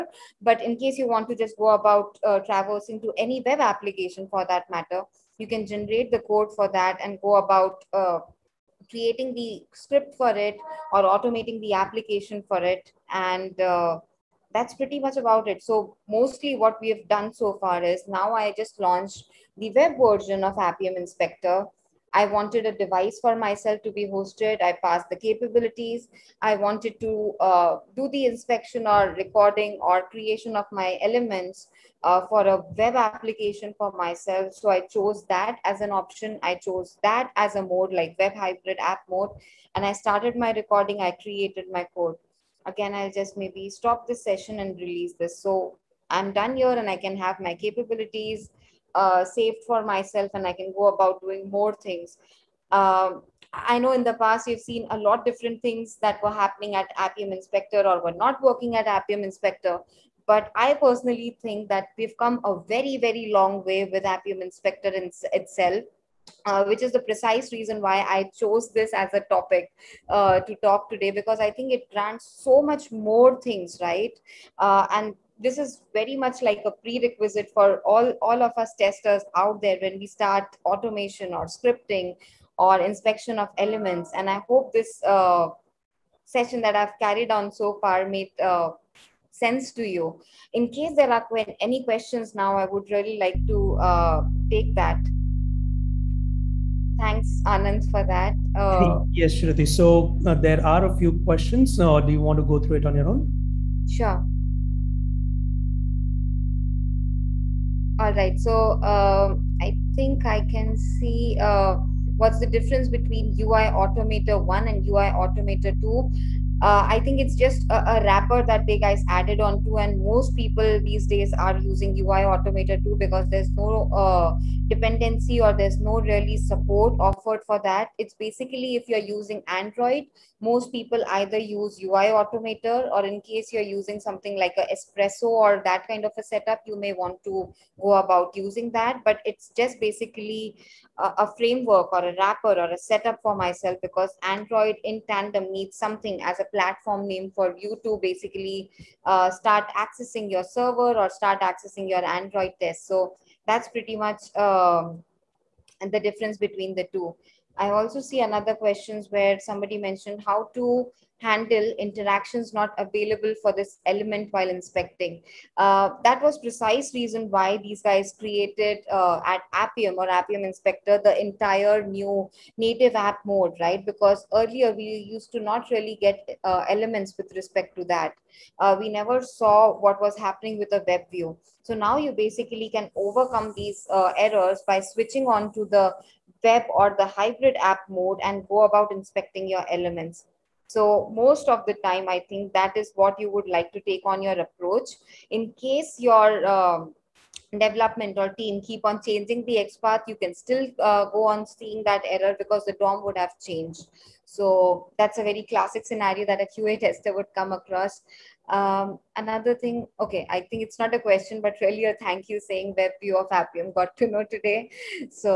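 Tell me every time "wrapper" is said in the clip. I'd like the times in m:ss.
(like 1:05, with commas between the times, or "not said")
1:58, 2:22.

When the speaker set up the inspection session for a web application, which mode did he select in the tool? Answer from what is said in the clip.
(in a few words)
web hybrid app mode.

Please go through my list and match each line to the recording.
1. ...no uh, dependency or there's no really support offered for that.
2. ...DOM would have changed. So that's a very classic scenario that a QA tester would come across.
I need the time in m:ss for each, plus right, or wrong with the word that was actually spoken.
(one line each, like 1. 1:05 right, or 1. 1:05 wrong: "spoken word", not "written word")
1. 2:03 right
2. 3:22 right.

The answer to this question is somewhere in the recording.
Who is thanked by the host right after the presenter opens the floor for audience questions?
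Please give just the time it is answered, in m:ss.
1:37.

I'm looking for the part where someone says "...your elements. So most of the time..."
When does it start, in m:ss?
3:09.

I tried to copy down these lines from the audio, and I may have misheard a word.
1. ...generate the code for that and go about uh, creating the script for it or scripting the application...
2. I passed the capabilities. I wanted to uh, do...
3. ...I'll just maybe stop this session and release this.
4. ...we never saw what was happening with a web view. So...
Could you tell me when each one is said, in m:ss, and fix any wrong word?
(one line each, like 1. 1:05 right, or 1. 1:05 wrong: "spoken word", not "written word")
1. 0:05 wrong: "automating", not "scripting"
2. 0:24 right
3. 0:42 right
4. 2:58 right.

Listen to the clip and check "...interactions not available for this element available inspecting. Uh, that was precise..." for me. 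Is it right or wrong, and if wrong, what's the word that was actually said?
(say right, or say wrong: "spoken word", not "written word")
wrong: "while", not "available".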